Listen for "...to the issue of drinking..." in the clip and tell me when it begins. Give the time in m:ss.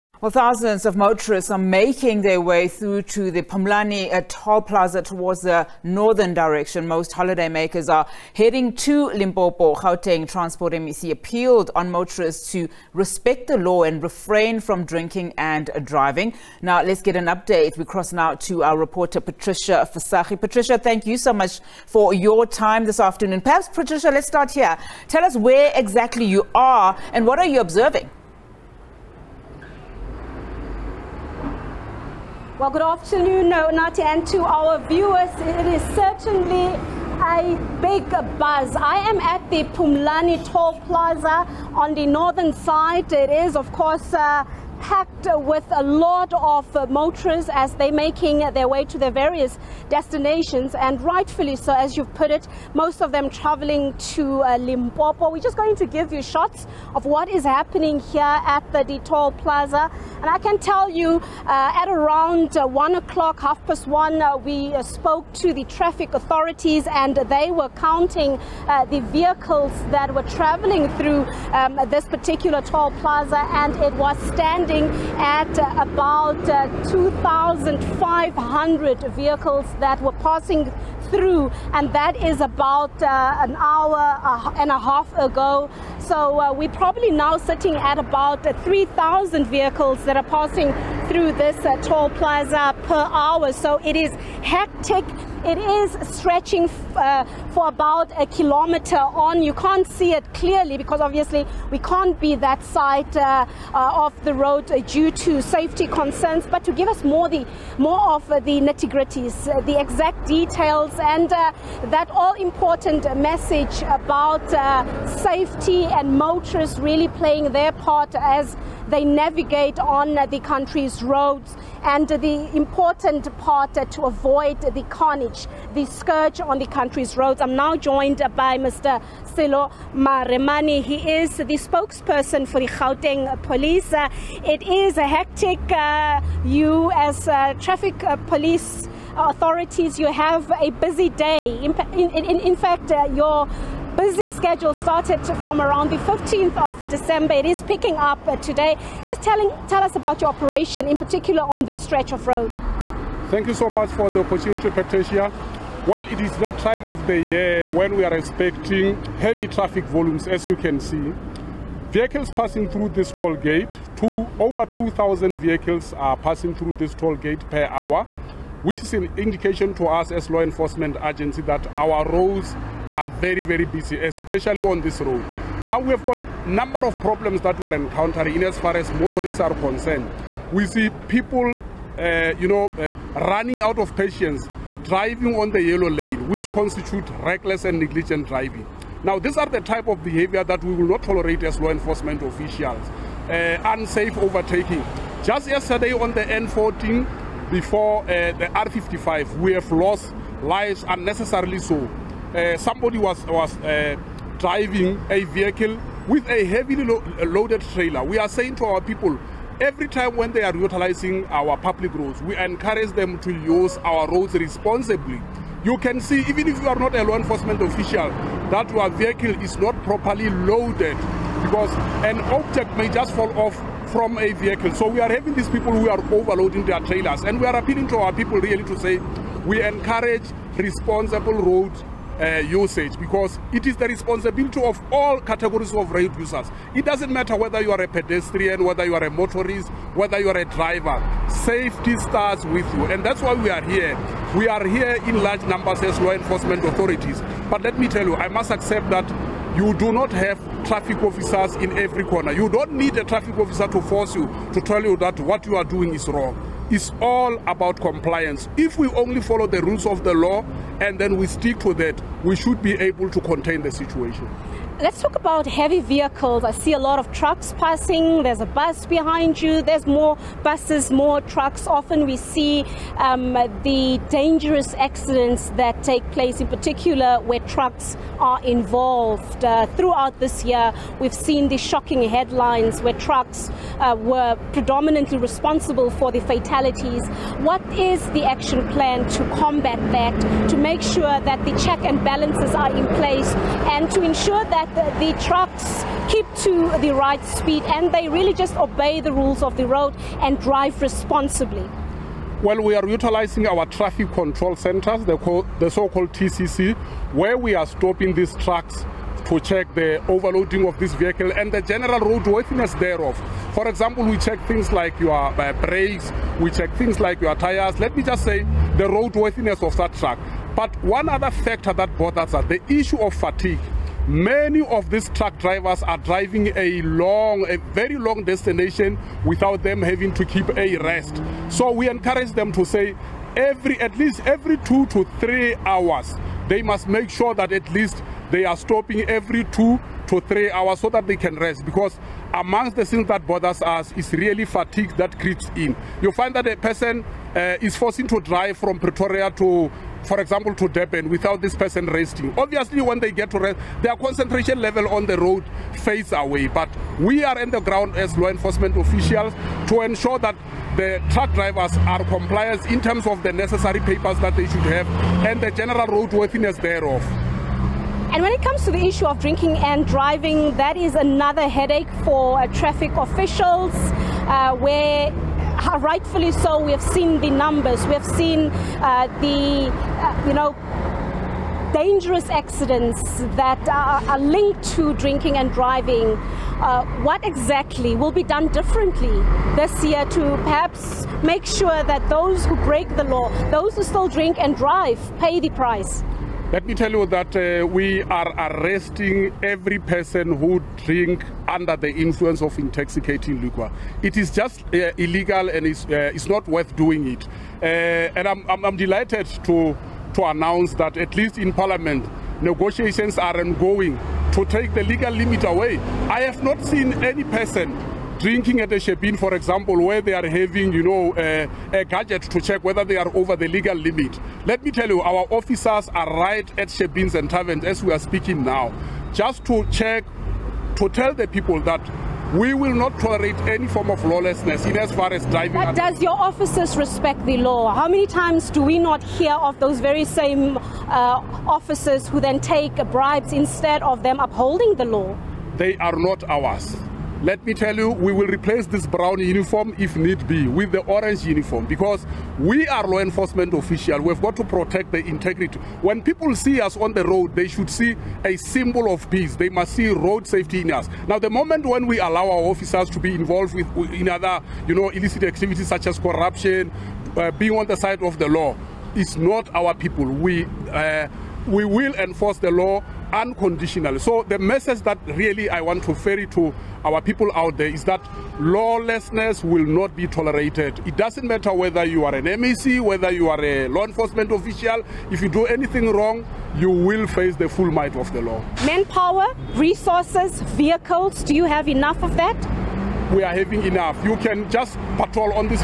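6:08.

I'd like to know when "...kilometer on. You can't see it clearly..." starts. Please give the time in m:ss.
1:38.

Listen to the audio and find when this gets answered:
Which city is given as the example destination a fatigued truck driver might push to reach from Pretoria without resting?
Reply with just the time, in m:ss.
5:50.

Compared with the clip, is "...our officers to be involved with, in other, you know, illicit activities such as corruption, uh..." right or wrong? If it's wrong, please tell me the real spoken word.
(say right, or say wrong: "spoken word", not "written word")
right.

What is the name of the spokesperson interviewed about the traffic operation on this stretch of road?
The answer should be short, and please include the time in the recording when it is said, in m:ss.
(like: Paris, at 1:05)
Sello Maremane, at 2:09.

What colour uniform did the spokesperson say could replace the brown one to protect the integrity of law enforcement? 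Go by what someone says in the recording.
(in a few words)
orange.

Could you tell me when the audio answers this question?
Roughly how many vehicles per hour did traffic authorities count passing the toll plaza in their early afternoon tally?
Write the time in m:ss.
1:16.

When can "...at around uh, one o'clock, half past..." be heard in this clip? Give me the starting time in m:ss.
1:01.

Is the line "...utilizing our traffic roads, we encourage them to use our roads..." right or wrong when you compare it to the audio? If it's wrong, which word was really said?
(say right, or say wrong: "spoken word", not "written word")
wrong: "public", not "traffic".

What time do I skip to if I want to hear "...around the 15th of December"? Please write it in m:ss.
2:25.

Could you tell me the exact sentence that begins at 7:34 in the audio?
We've got to protect the integrity.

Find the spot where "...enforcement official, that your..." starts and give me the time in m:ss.
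3:37.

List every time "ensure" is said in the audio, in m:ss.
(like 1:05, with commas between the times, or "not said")
4:54, 5:59.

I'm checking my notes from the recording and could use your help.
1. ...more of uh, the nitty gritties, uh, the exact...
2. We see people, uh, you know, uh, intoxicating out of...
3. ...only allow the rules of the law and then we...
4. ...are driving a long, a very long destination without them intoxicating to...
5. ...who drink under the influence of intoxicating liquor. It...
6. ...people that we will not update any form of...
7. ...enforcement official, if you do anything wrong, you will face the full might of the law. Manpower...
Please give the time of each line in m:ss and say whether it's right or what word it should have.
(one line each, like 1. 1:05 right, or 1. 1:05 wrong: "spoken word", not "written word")
1. 1:47 right
2. 3:00 wrong: "running", not "intoxicating"
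3. 4:18 wrong: "follow", not "allow"
4. 5:25 wrong: "having", not "intoxicating"
5. 6:40 right
6. 7:11 wrong: "tolerate", not "update"
7. 8:03 right.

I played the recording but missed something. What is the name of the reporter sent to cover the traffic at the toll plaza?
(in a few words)
Patricia Visagie.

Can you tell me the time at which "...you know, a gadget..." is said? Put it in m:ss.
7:00.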